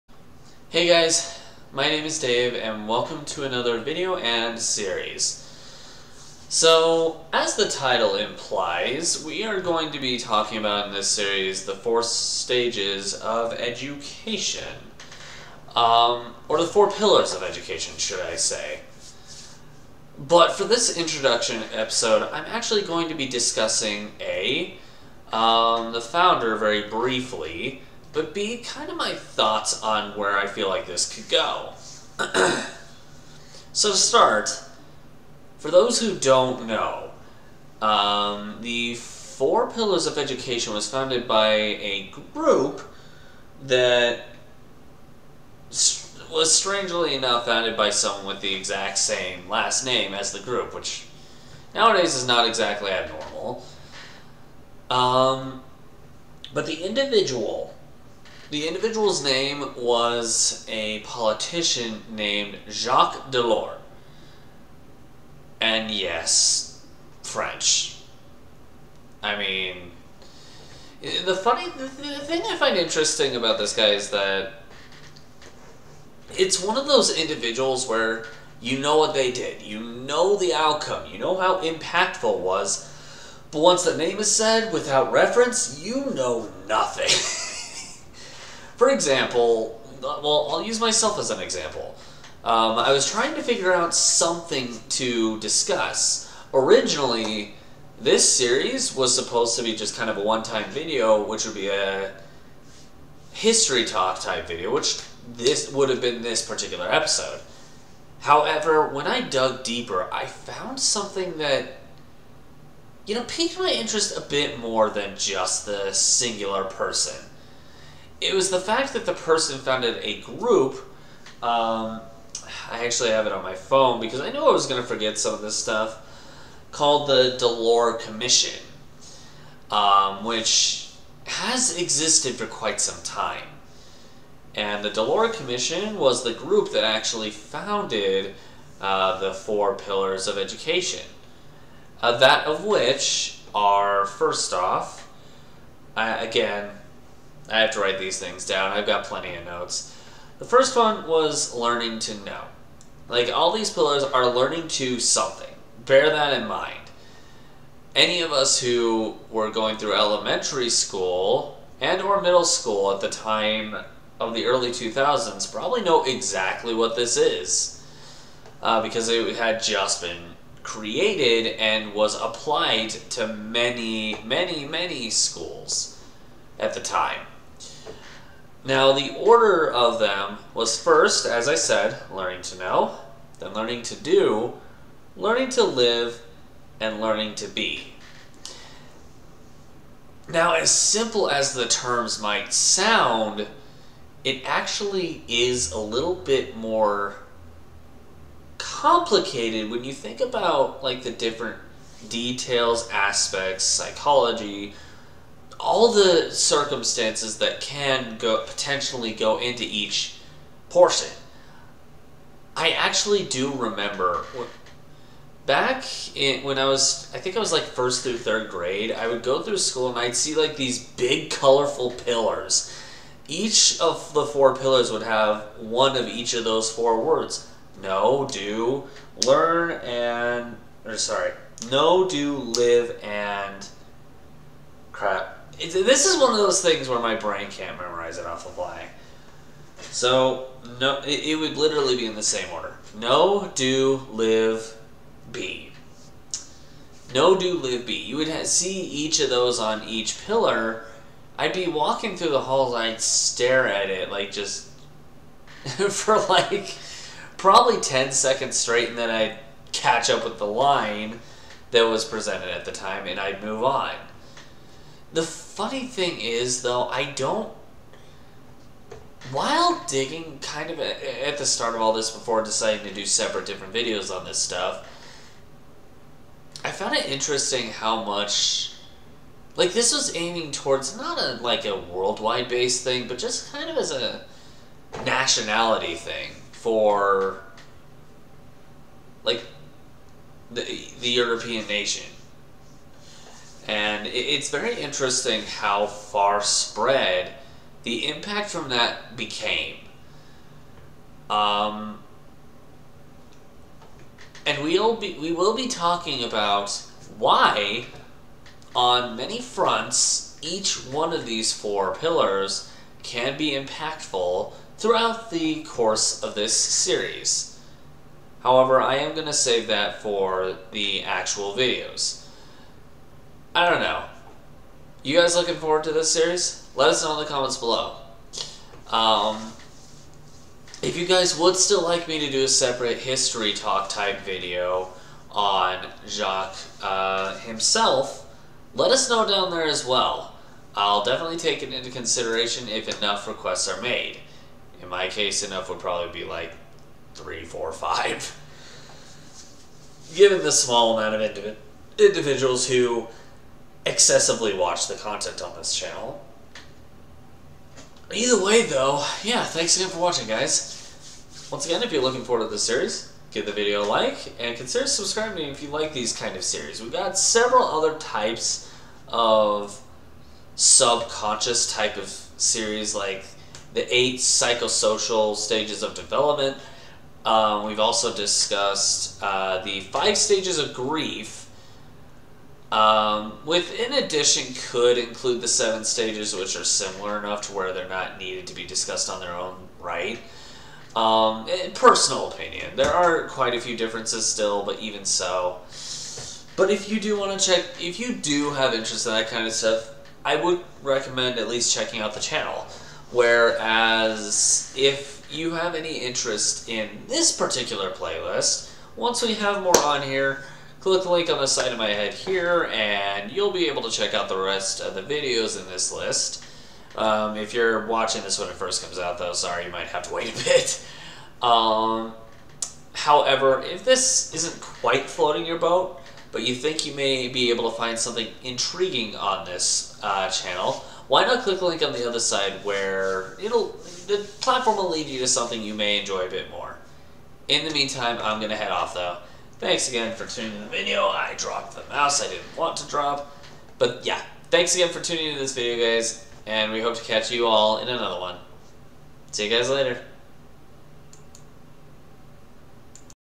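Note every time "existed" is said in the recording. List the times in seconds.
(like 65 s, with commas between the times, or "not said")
131 s.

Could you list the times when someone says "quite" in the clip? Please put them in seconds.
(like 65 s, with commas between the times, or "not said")
132 s, 393 s, 424 s.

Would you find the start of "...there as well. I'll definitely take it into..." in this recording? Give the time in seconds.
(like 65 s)
339 s.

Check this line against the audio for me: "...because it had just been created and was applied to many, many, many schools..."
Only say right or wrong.
right.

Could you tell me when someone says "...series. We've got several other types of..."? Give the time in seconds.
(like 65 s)
366 s.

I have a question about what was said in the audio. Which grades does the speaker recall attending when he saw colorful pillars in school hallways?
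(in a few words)
First through third grade.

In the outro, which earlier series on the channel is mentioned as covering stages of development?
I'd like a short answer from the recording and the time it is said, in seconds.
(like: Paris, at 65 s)
Eight psychosocial stages of development, at 373 s.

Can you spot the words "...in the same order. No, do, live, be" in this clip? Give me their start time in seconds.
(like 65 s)
242 s.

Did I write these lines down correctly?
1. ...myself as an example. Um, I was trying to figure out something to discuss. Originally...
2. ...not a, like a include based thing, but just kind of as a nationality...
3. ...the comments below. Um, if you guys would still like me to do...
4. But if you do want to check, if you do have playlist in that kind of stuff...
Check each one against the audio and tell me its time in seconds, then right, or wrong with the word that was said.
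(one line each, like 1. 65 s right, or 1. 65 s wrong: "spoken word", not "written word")
1. 90 s right
2. 280 s wrong: "worldwide", not "include"
3. 327 s right
4. 396 s wrong: "interest", not "playlist".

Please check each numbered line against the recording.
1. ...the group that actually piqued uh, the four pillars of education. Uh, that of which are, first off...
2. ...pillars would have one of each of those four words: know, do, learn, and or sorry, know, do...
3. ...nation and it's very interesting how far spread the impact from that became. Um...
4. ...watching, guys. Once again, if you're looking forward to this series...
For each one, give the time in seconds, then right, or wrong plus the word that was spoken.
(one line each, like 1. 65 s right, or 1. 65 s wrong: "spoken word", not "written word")
1. 136 s wrong: "founded", not "piqued"
2. 224 s right
3. 291 s right
4. 359 s right.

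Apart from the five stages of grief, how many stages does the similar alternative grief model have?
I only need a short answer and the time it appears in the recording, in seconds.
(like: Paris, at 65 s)
7, at 385 s.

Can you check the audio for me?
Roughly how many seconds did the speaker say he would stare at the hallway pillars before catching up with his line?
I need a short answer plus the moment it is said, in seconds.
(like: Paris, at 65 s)
10, at 257 s.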